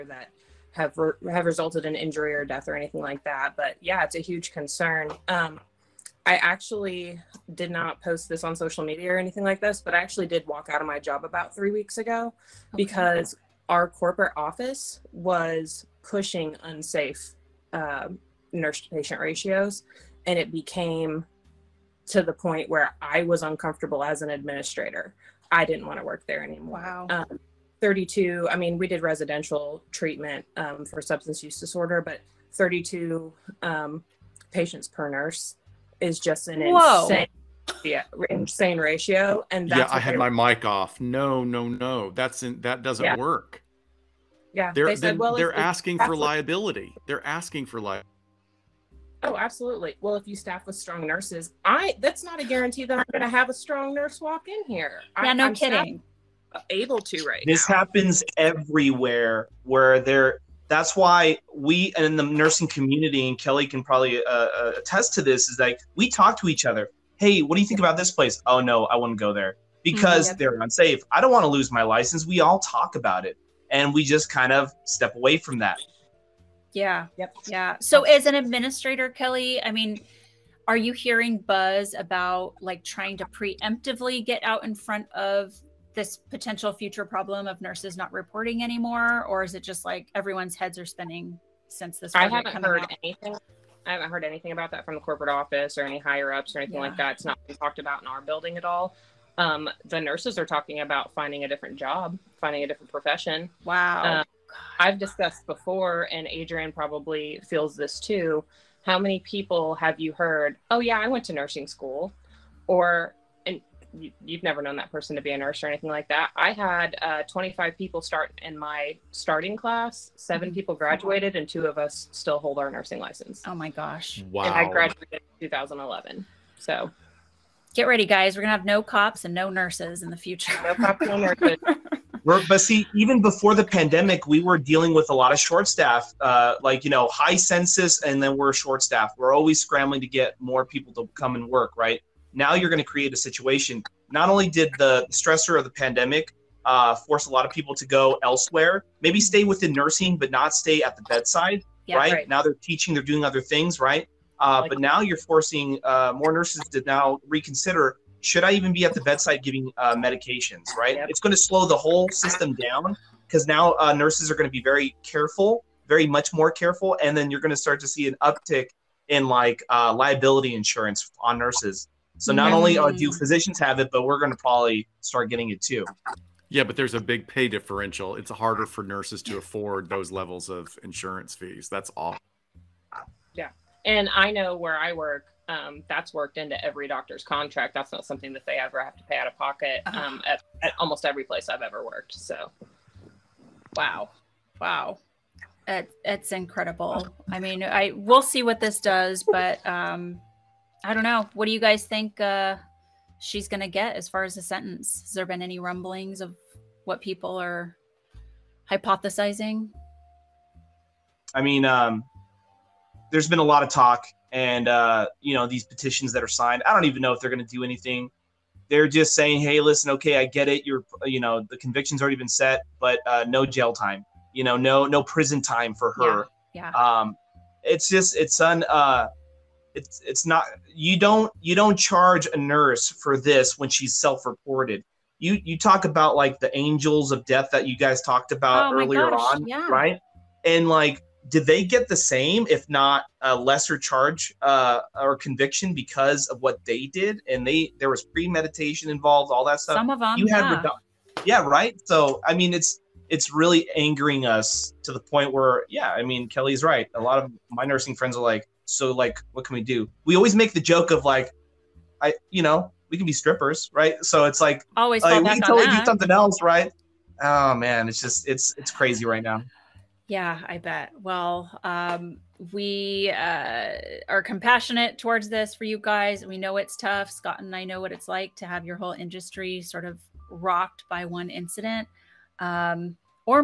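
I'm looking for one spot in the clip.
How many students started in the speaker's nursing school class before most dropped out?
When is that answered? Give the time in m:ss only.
1:57.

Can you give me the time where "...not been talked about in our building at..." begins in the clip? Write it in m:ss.
1:37.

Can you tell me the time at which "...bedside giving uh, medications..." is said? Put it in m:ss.
2:38.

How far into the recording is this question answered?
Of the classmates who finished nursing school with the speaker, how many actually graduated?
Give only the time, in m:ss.
2:00.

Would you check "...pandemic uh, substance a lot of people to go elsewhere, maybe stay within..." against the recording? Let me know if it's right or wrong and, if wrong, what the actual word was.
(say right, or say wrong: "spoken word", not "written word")
wrong: "force", not "substance".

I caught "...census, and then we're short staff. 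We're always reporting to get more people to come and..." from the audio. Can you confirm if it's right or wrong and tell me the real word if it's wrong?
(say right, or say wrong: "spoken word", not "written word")
wrong: "scrambling", not "reporting".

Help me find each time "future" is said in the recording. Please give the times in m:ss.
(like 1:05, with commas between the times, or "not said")
1:26, 2:10.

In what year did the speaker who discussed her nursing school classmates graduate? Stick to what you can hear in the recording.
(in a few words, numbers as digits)
2011.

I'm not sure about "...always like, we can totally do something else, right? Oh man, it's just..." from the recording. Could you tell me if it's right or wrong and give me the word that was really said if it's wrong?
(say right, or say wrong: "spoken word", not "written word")
right.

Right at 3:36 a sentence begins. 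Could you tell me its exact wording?
I don't even know if they're going to do anything.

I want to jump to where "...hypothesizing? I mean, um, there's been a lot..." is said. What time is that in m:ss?
3:28.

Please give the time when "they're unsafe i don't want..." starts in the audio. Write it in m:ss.
1:10.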